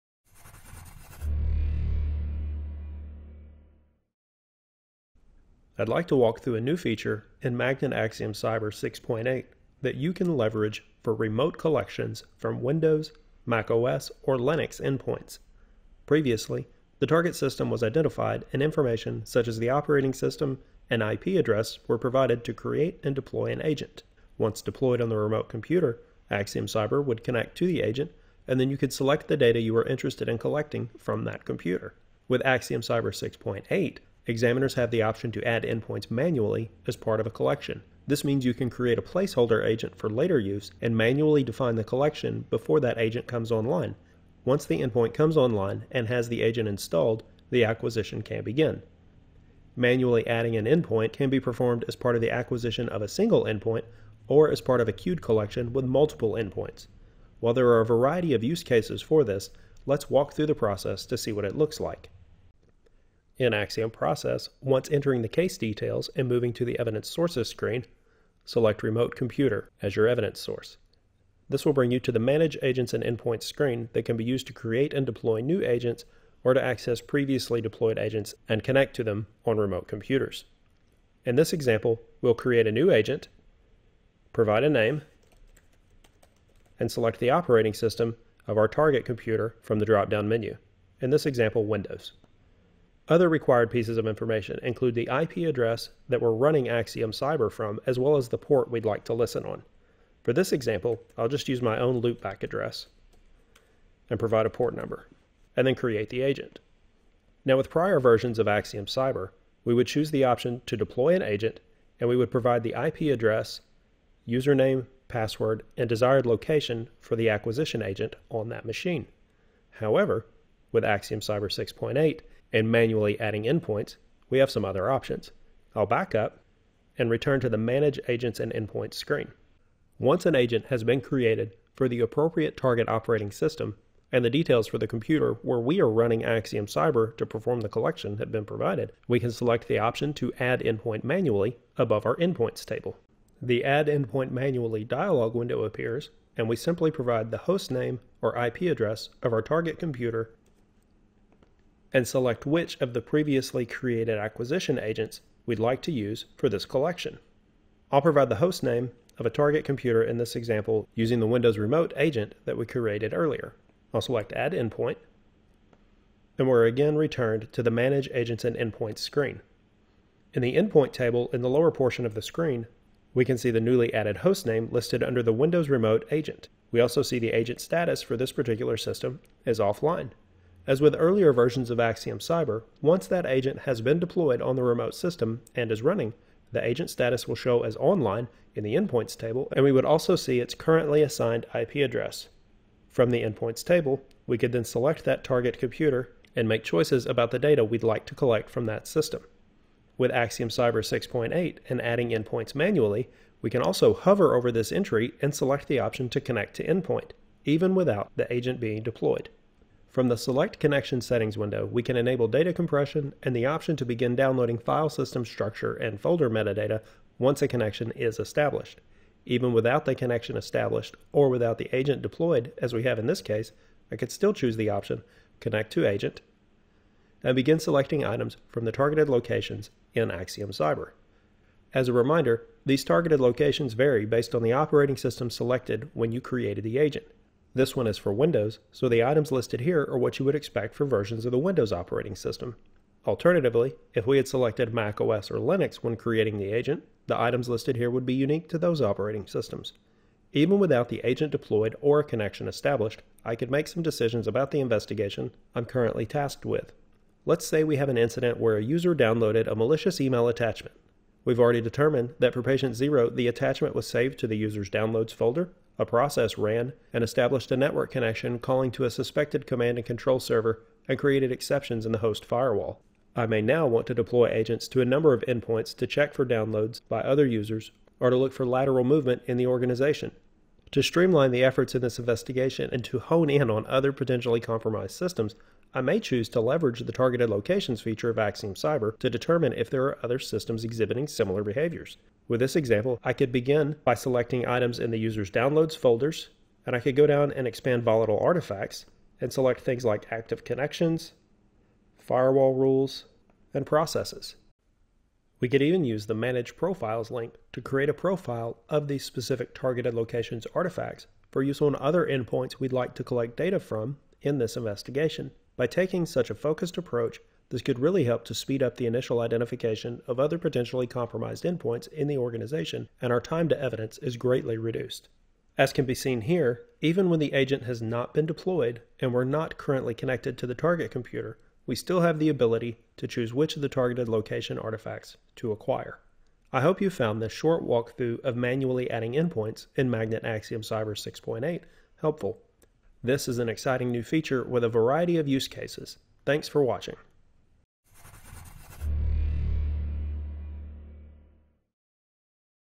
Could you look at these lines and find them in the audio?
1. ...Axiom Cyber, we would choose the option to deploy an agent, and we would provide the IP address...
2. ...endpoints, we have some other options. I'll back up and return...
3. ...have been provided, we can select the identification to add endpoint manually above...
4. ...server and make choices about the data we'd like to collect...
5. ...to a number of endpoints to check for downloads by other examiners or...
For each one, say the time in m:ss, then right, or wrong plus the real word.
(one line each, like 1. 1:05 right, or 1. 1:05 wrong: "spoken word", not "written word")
1. 1:48 right
2. 2:03 right
3. 2:18 wrong: "option", not "identification"
4. 3:15 wrong: "computer", not "server"
5. 4:34 wrong: "users", not "examiners".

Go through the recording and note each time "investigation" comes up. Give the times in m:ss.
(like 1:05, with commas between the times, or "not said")
4:14, 4:41, 5:14.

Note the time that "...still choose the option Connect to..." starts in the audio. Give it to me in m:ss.
3:44.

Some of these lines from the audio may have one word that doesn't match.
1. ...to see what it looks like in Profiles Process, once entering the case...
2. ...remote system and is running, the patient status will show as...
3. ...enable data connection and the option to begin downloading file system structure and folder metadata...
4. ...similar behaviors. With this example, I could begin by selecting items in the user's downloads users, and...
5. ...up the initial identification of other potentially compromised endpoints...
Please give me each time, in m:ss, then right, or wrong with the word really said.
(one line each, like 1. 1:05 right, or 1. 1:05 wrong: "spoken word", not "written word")
1. 1:01 wrong: "Axiom", not "Profiles"
2. 3:04 wrong: "agent", not "patient"
3. 3:31 wrong: "compression", not "connection"
4. 4:51 wrong: "folders", not "users"
5. 5:18 right.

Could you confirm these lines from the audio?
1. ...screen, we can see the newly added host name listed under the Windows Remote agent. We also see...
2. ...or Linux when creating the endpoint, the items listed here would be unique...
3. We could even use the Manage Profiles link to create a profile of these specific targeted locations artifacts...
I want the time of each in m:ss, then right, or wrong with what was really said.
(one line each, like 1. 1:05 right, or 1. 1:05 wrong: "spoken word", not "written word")
1. 2:52 right
2. 4:05 wrong: "agent", not "endpoint"
3. 5:05 right.